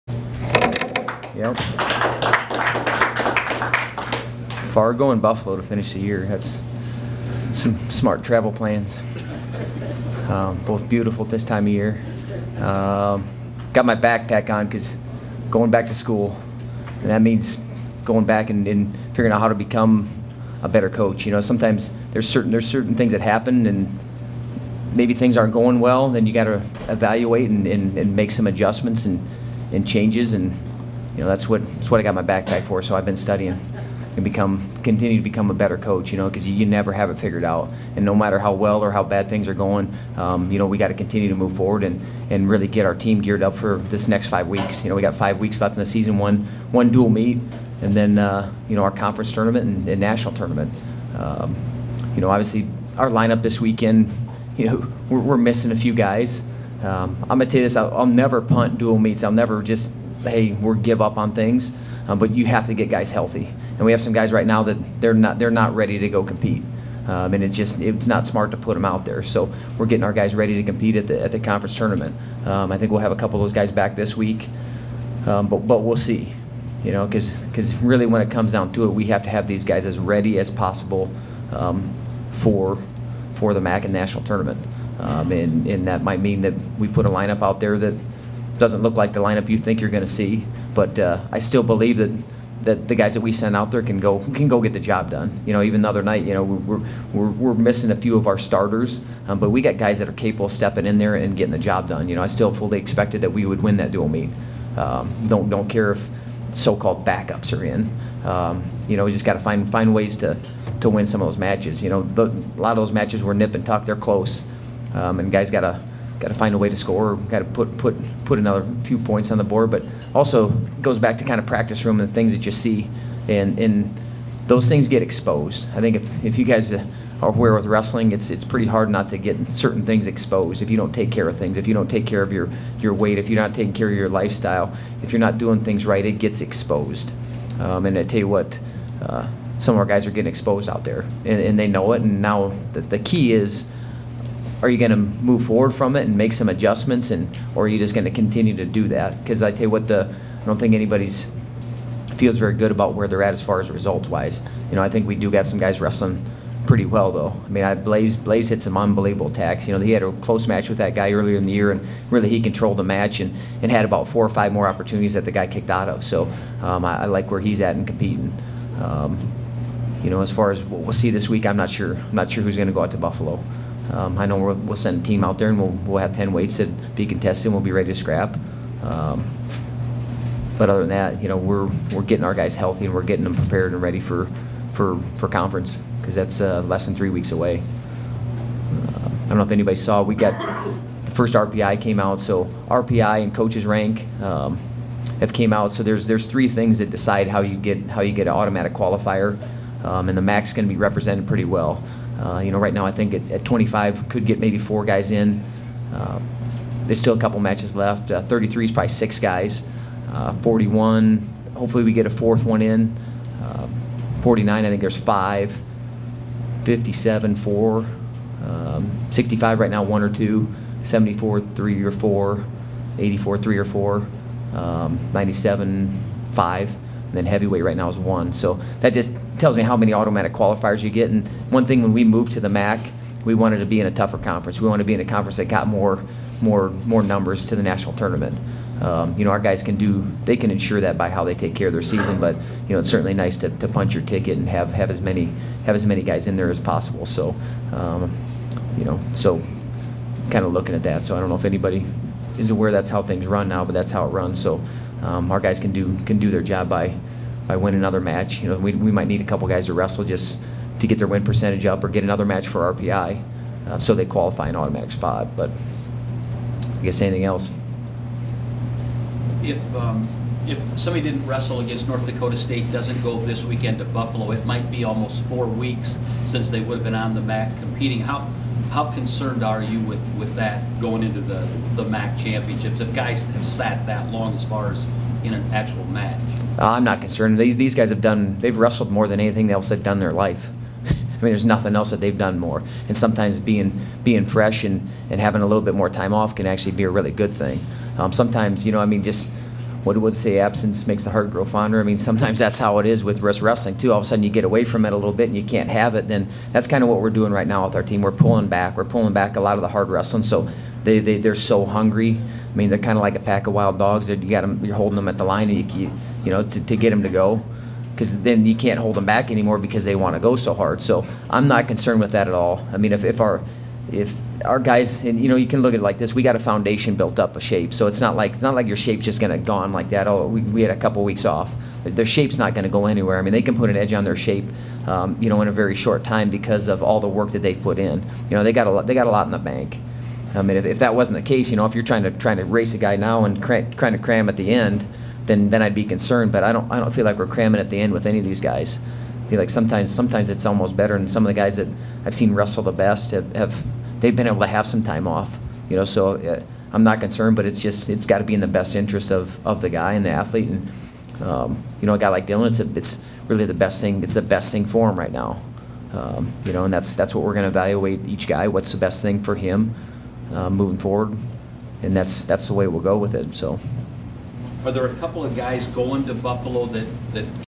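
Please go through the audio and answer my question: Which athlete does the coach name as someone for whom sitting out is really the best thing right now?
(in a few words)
Dylan.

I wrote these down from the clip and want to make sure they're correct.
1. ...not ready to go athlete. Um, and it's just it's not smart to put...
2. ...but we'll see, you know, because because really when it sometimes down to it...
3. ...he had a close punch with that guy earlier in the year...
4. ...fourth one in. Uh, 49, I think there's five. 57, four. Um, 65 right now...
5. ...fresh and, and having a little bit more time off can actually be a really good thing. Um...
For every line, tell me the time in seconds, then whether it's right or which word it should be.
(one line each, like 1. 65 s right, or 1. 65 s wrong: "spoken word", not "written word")
1. 65 s wrong: "compete", not "athlete"
2. 75 s wrong: "comes", not "sometimes"
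3. 159 s wrong: "match", not "punch"
4. 212 s right
5. 294 s right.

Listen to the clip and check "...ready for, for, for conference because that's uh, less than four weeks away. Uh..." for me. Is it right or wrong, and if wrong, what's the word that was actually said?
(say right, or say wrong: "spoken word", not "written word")
wrong: "three", not "four".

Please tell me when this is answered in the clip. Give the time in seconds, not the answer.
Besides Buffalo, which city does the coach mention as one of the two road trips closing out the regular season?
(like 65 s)
4 s.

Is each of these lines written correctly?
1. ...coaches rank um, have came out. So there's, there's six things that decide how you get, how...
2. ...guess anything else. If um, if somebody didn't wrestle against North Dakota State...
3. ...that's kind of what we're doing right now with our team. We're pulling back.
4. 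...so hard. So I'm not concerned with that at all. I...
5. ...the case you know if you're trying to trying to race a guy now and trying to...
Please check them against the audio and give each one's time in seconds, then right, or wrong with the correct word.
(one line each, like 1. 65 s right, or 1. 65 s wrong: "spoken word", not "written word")
1. 193 s wrong: "three", not "six"
2. 266 s right
3. 306 s right
4. 320 s right
5. 341 s right.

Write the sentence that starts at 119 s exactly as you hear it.
But also goes back to kind of practice room and the things that you see, and and those things get exposed.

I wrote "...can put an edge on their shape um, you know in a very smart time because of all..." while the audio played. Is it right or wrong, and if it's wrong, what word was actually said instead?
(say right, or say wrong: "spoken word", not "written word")
wrong: "short", not "smart".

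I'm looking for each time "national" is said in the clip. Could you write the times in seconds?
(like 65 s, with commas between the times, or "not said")
49 s, 83 s, 237 s.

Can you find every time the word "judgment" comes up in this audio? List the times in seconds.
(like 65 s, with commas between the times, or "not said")
not said.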